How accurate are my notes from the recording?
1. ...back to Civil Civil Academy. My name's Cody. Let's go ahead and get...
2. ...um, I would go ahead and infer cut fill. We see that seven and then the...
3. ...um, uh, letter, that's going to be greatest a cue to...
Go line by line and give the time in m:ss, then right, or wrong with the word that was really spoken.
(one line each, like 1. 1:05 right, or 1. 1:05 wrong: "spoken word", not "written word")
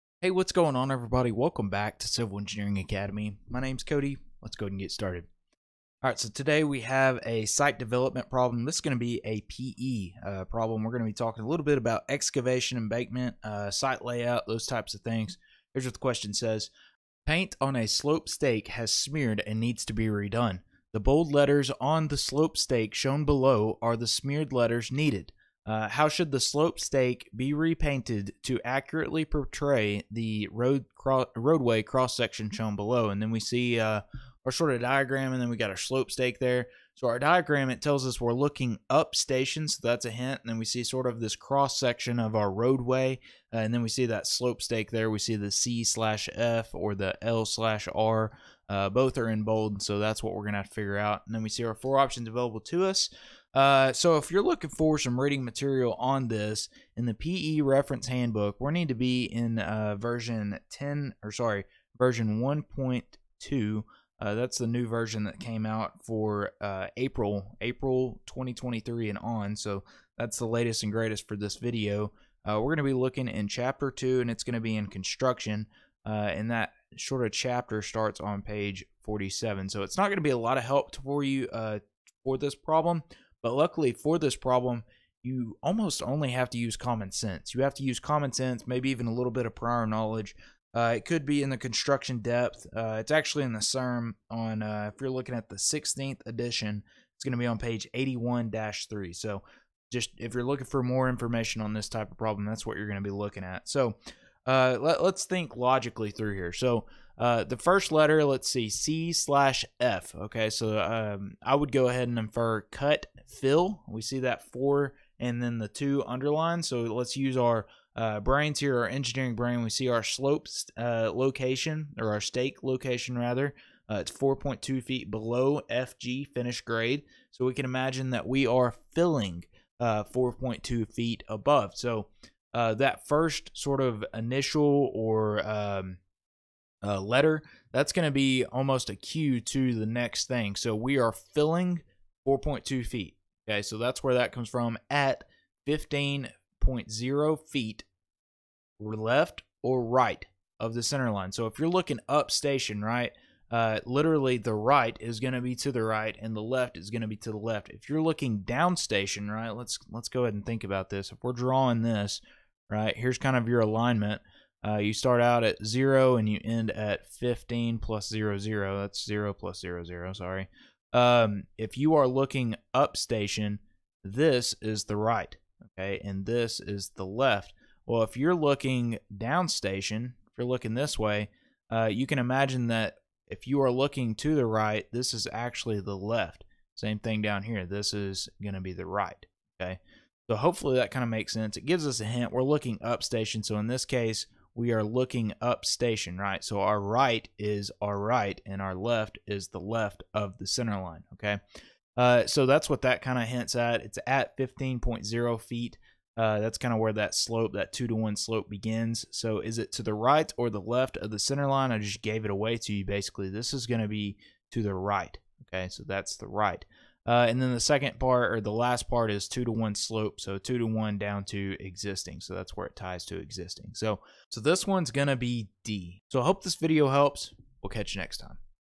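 1. 0:01 wrong: "Engineering", not "Civil"
2. 1:50 wrong: "four", not "seven"
3. 2:15 wrong: "almost", not "greatest".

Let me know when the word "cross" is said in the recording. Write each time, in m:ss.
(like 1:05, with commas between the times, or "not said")
0:31, 0:41.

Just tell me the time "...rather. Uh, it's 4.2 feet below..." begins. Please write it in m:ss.
2:03.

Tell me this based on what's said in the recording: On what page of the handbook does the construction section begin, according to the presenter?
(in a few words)
47.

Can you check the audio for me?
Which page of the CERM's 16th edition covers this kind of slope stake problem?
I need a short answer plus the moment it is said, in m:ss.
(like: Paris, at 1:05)
81-3, at 1:37.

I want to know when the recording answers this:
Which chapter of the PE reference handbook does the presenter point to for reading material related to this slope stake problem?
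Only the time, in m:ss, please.
1:13.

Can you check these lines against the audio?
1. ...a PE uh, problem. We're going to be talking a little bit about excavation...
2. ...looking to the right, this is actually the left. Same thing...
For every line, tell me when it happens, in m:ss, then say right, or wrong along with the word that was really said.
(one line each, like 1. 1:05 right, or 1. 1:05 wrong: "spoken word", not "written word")
1. 0:09 right
2. 3:03 right.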